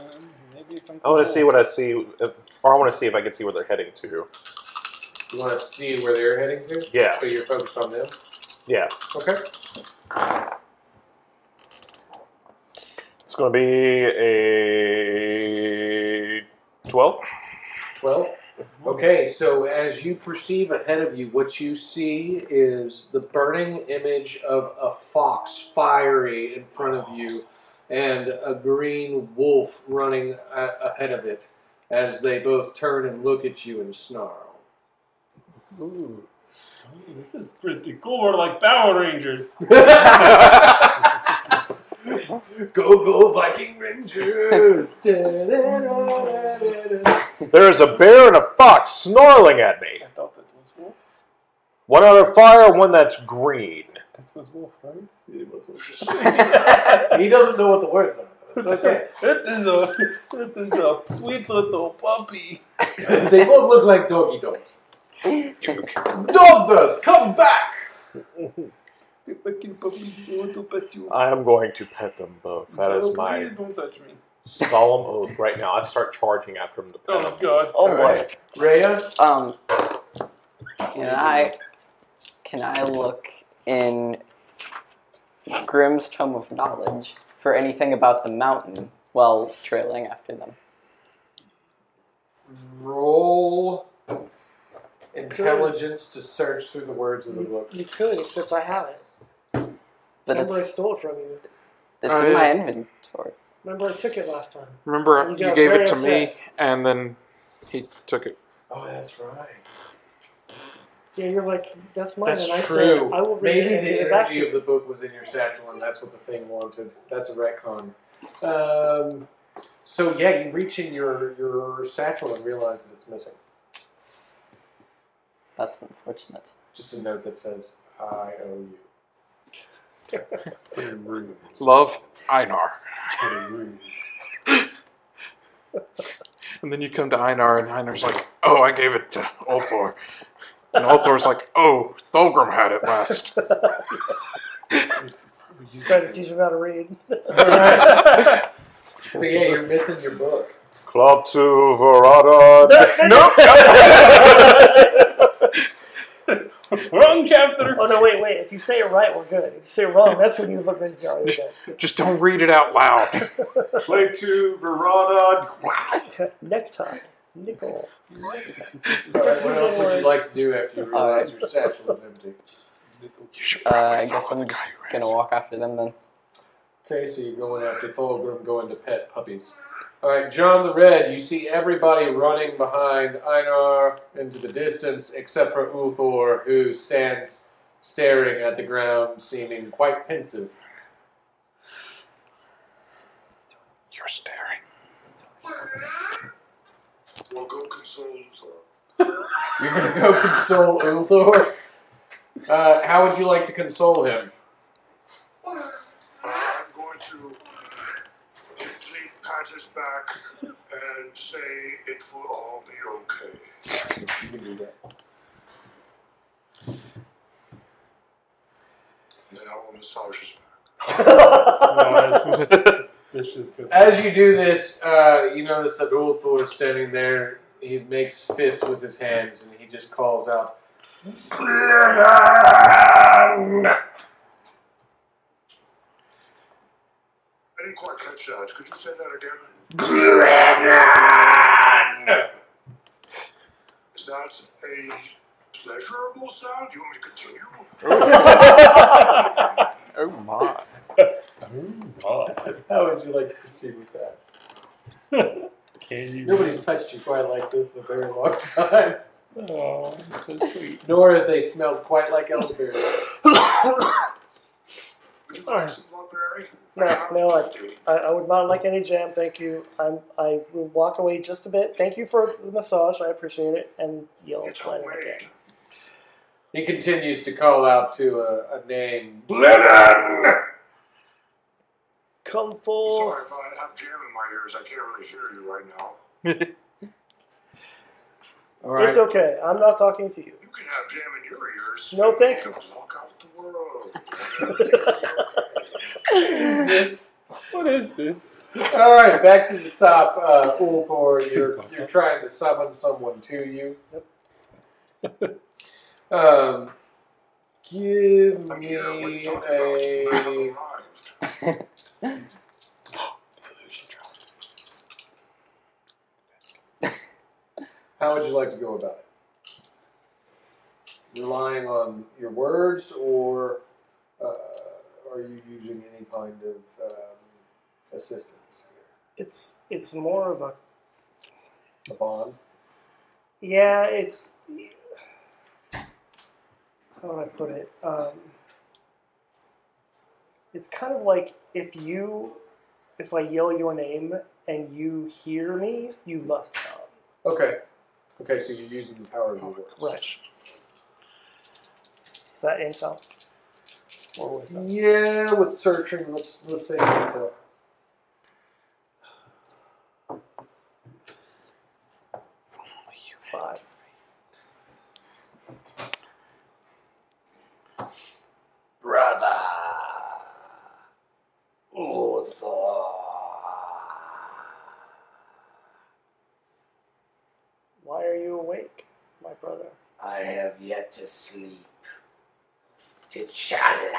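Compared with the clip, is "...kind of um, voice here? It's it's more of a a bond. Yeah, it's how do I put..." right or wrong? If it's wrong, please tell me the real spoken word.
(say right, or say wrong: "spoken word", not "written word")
wrong: "assistance", not "voice".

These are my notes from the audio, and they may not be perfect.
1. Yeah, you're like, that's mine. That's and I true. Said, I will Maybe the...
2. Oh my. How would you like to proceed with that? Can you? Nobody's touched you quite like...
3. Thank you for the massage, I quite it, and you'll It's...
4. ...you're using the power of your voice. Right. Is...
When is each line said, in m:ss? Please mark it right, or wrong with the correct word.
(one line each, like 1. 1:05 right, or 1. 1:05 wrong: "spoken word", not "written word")
1. 1:51 right
2. 4:12 right
3. 4:31 wrong: "appreciate", not "quite"
4. 5:48 right.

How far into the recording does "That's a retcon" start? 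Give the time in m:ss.
1:57.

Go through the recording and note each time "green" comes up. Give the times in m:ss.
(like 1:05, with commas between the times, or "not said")
0:28, 0:53.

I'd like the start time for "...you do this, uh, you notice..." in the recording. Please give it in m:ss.
3:44.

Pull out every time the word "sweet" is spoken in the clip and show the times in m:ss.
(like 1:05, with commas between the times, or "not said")
1:01, 4:20.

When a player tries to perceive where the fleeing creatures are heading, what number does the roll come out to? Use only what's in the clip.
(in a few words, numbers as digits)
12.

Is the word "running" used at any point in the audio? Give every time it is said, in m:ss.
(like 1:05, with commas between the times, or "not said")
0:29, 3:02.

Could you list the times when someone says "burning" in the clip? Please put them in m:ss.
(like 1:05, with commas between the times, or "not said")
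0:23.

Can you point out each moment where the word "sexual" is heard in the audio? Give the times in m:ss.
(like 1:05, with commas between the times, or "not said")
not said.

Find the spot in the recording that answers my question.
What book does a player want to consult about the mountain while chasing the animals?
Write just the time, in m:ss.
1:25.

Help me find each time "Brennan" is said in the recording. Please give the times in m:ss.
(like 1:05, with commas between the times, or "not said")
3:51.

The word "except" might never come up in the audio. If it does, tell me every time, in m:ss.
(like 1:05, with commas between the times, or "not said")
1:38, 3:05.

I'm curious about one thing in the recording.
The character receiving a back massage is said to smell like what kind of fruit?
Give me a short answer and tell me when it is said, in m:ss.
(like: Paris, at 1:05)
elderberry, at 4:22.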